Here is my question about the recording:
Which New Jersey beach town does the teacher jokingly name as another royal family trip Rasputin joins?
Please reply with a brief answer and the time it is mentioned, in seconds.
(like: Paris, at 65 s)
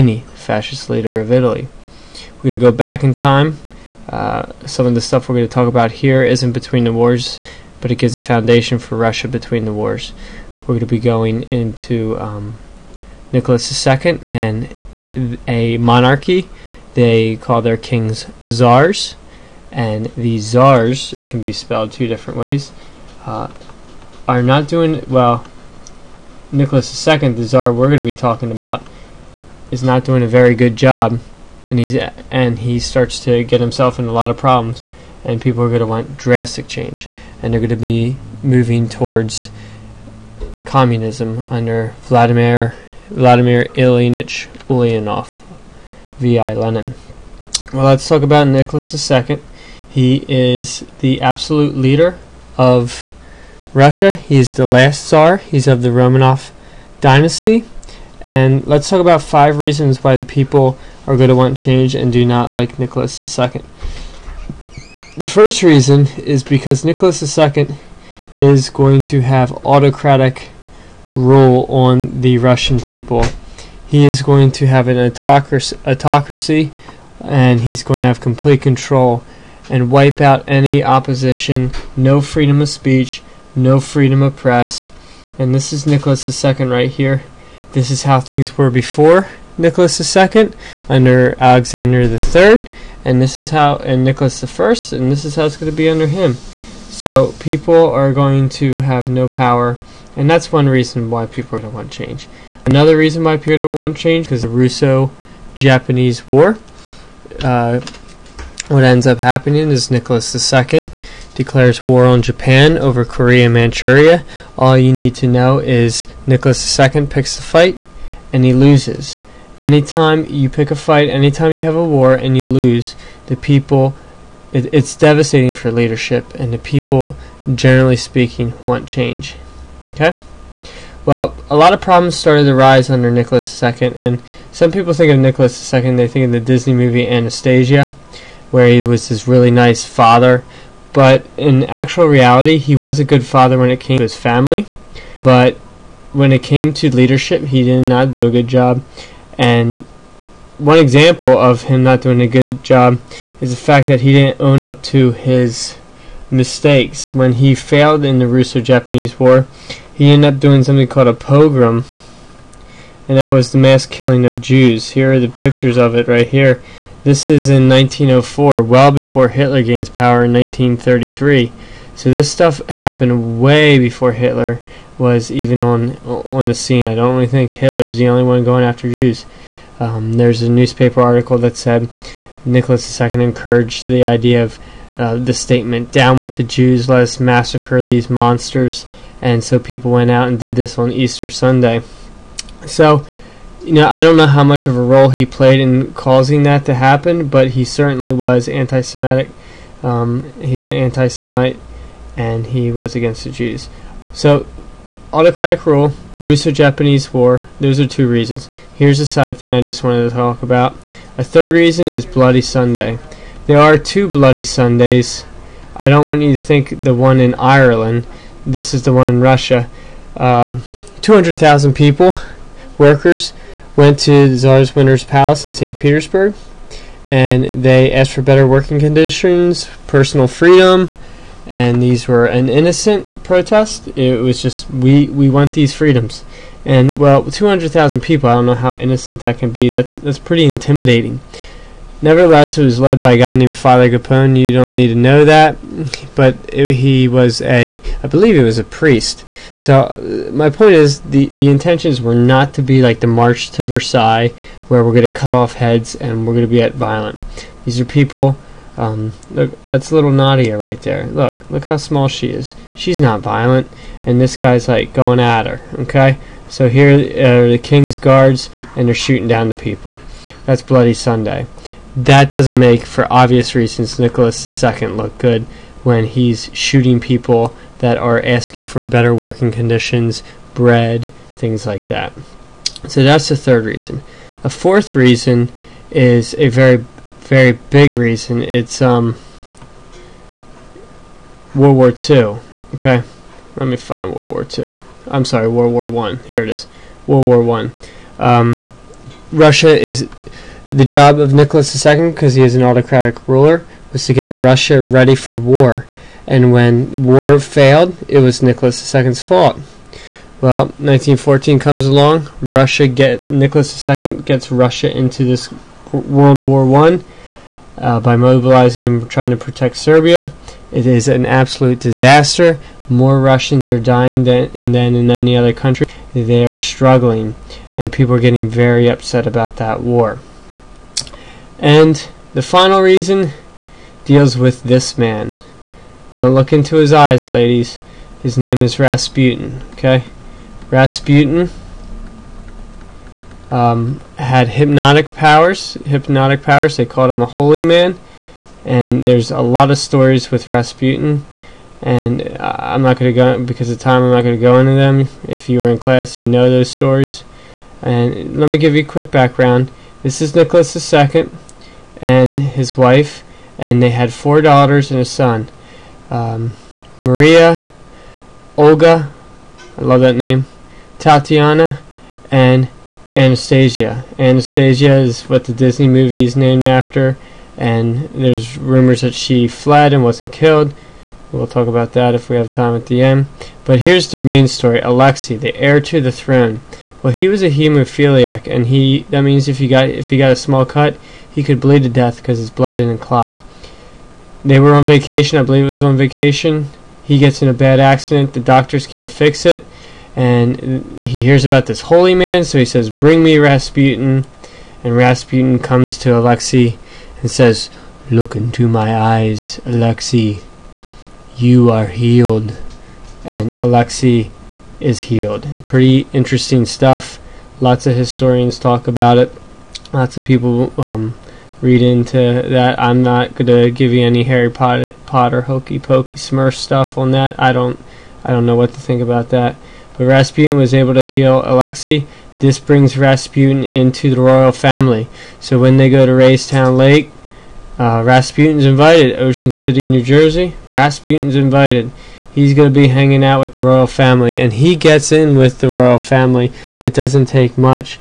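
Ocean City, at 439 s.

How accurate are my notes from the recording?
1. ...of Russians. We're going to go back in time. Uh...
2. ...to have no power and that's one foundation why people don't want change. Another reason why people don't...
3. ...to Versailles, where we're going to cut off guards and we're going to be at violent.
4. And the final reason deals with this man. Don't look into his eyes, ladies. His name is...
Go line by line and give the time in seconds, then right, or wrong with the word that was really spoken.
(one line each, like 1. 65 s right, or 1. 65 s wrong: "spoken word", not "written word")
1. 1 s wrong: "Italy", not "Russians"
2. 98 s wrong: "reason", not "foundation"
3. 253 s wrong: "heads", not "guards"
4. 331 s right.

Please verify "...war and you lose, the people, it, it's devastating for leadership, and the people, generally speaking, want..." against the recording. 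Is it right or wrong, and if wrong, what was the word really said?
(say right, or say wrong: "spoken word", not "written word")
right.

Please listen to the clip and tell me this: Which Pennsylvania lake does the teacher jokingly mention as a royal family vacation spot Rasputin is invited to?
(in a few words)
Raystown Lake.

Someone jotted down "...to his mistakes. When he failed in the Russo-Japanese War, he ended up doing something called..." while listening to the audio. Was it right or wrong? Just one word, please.
right.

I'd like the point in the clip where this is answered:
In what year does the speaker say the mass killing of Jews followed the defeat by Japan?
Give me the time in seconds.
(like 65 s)
167 s.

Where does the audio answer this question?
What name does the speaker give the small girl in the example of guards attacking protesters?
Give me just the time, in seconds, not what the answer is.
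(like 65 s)
260 s.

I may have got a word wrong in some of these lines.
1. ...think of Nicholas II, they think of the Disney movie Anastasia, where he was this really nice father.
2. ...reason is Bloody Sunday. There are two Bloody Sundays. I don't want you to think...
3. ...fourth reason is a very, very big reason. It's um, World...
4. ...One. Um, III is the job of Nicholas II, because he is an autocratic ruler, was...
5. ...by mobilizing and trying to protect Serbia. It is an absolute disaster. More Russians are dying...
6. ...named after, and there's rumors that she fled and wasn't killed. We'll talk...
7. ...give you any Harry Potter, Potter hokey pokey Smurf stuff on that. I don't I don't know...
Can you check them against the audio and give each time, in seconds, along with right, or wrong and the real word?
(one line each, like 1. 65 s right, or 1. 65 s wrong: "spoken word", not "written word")
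1. 134 s right
2. 211 s right
3. 284 s right
4. 297 s wrong: "Russia", not "III"
5. 317 s right
6. 376 s right
7. 423 s right.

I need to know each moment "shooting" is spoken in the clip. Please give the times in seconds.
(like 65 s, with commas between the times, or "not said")
268 s, 276 s.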